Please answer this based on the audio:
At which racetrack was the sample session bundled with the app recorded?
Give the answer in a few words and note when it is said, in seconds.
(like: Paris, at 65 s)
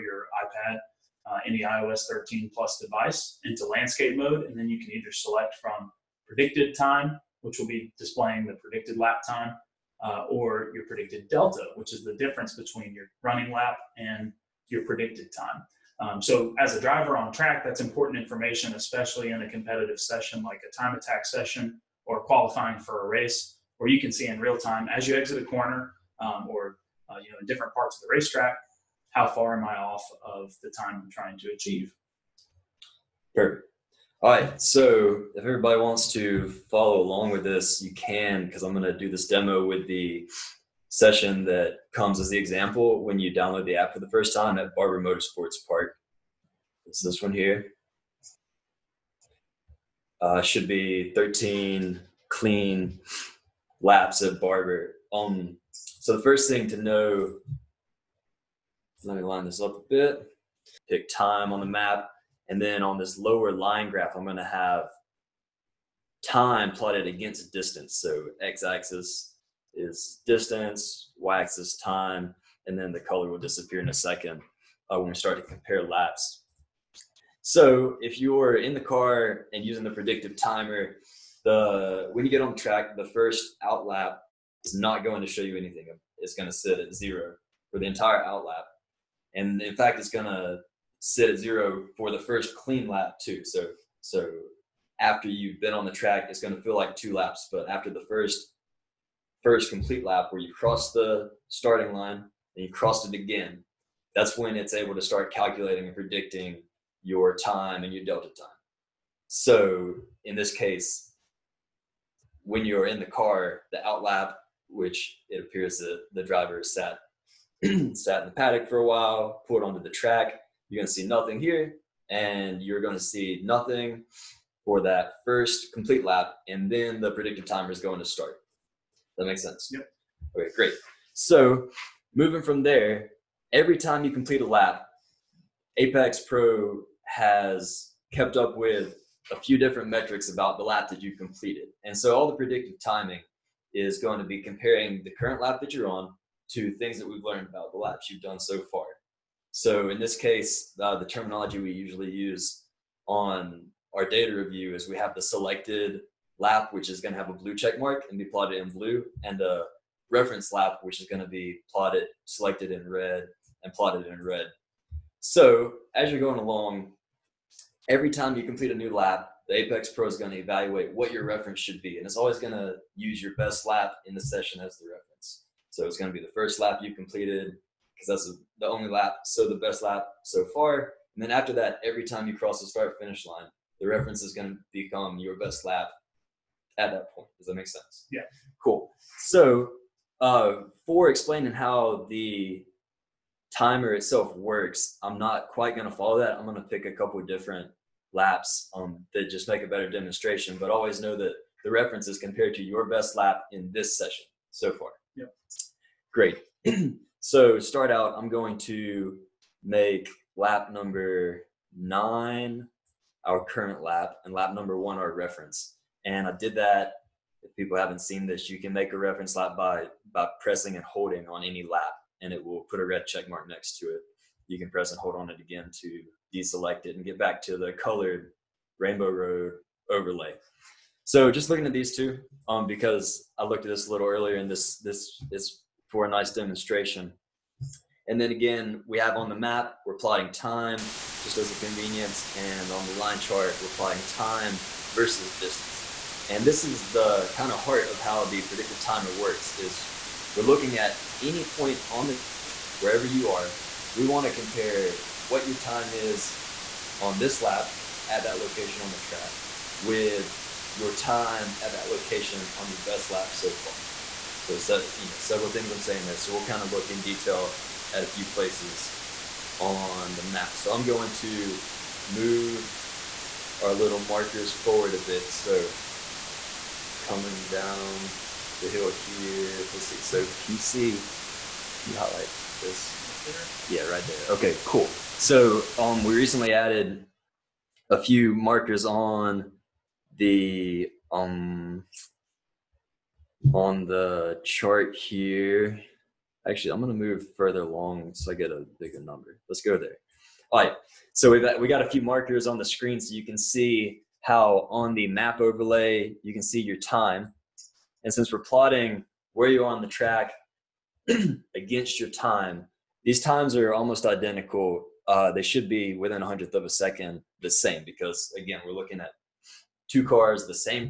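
Barber Motorsports Park, at 44 s.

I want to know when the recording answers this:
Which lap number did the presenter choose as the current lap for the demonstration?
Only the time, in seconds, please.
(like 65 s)
211 s.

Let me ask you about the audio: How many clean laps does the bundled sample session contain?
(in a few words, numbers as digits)
13.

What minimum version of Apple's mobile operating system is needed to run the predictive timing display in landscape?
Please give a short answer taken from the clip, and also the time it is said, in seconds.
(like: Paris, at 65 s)
iOS 13, at 1 s.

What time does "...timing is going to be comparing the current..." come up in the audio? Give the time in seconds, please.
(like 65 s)
142 s.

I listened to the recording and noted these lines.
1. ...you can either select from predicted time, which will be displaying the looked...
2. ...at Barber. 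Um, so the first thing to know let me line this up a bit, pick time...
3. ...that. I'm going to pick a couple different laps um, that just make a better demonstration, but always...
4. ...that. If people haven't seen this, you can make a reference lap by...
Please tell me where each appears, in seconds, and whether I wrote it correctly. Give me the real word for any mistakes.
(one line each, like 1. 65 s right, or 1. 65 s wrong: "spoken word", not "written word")
1. 4 s wrong: "predicted", not "looked"
2. 54 s right
3. 196 s right
4. 216 s right.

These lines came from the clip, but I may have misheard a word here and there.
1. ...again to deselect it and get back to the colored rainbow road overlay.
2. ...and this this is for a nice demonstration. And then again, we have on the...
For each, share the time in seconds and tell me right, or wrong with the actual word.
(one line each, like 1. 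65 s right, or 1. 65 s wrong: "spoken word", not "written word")
1. 225 s right
2. 234 s right.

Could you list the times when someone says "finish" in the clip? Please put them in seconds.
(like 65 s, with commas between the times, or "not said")
182 s.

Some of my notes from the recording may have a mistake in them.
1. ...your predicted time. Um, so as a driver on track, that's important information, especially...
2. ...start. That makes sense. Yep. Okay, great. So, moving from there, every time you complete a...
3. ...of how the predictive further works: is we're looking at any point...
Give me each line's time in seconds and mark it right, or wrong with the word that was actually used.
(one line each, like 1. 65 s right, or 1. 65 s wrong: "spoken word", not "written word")
1. 14 s right
2. 128 s right
3. 247 s wrong: "timer", not "further".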